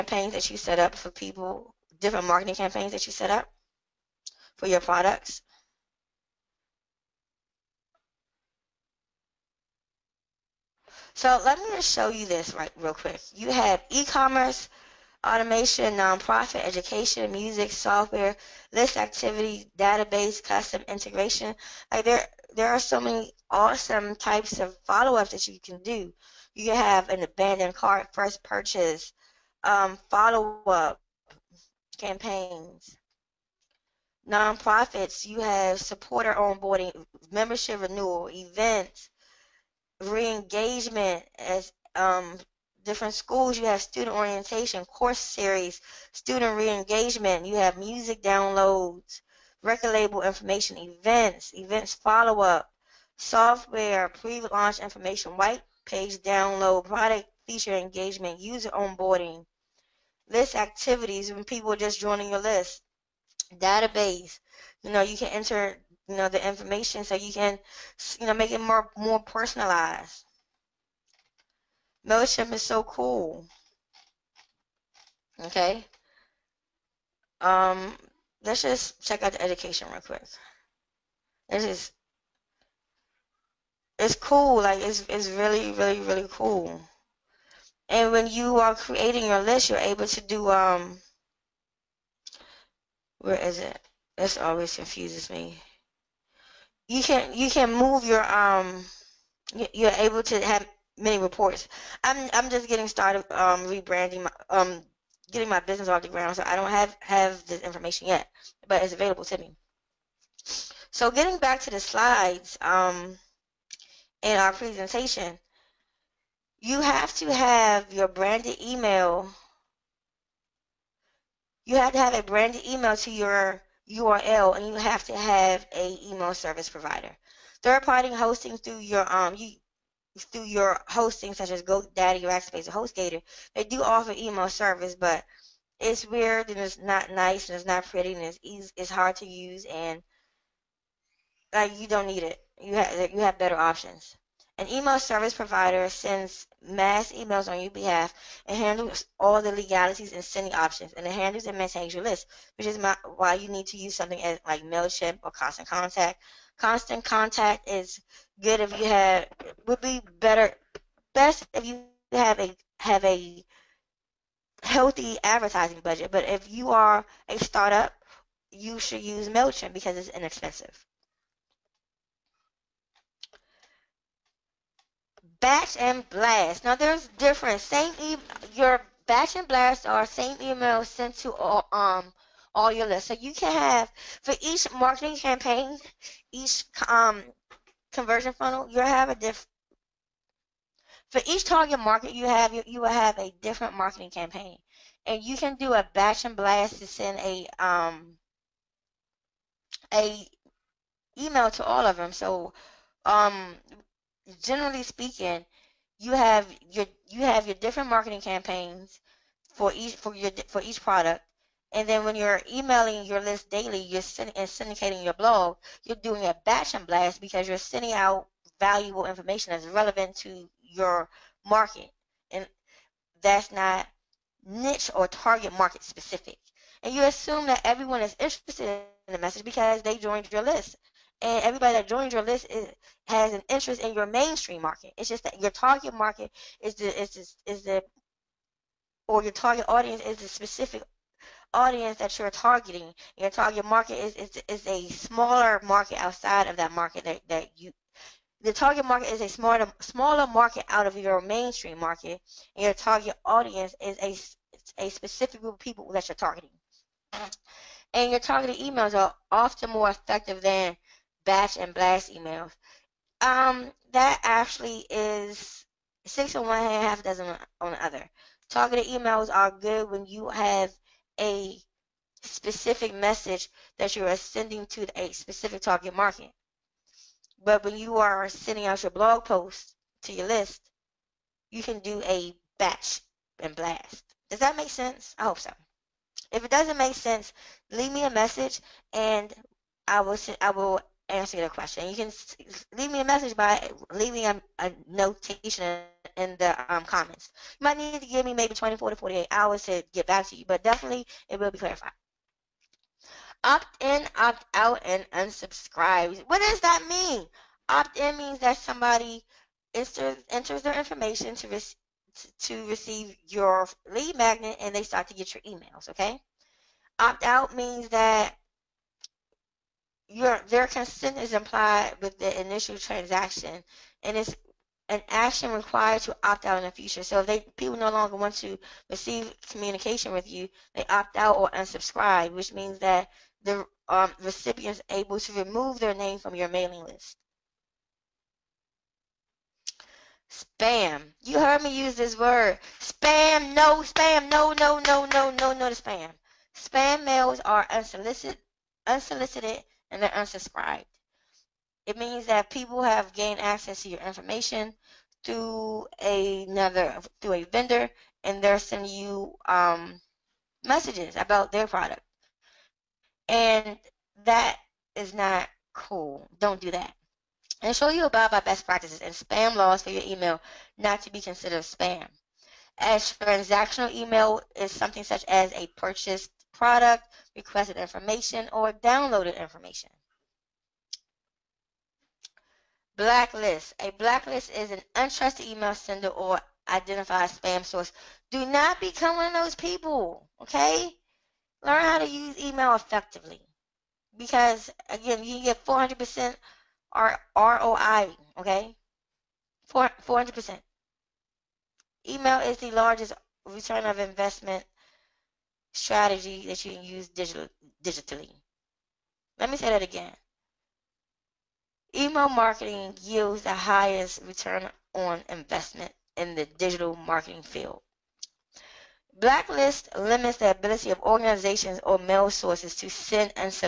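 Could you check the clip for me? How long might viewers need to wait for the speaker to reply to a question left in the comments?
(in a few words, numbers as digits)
24 to 48 hours.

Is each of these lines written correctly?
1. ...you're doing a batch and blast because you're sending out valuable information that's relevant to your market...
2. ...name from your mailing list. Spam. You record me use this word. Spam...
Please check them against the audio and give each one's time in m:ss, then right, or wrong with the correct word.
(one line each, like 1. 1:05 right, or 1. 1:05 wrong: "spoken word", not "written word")
1. 3:35 right
2. 5:35 wrong: "heard", not "record".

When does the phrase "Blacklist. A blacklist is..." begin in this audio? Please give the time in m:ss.
6:22.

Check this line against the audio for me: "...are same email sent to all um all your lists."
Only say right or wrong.
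right.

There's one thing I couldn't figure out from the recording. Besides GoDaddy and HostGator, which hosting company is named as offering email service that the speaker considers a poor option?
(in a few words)
Rackspace.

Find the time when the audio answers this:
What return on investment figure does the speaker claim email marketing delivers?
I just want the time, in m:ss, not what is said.
6:35.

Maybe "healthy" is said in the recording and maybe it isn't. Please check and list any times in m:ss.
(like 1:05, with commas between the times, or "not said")
2:44.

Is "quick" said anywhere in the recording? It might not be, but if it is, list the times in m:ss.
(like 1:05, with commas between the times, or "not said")
0:12, 1:20.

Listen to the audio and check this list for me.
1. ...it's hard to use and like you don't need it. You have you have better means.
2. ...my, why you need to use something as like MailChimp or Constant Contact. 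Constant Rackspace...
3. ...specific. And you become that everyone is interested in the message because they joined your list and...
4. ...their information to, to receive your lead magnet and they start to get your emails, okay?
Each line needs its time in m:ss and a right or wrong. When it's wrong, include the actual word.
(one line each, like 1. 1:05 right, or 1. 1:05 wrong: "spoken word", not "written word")
1. 2:18 wrong: "options", not "means"
2. 2:32 wrong: "Contact", not "Rackspace"
3. 3:45 wrong: "assume", not "become"
4. 5:10 right.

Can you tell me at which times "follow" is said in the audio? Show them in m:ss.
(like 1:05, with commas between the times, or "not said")
0:24, 0:30, 0:51.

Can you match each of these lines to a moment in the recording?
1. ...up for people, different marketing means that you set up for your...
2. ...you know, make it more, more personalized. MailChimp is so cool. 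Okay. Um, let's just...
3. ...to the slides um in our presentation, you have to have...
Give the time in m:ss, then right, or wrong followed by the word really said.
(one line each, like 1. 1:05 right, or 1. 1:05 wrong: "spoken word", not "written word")
1. 0:00 wrong: "campaigns", not "means"
2. 1:08 right
3. 1:51 right.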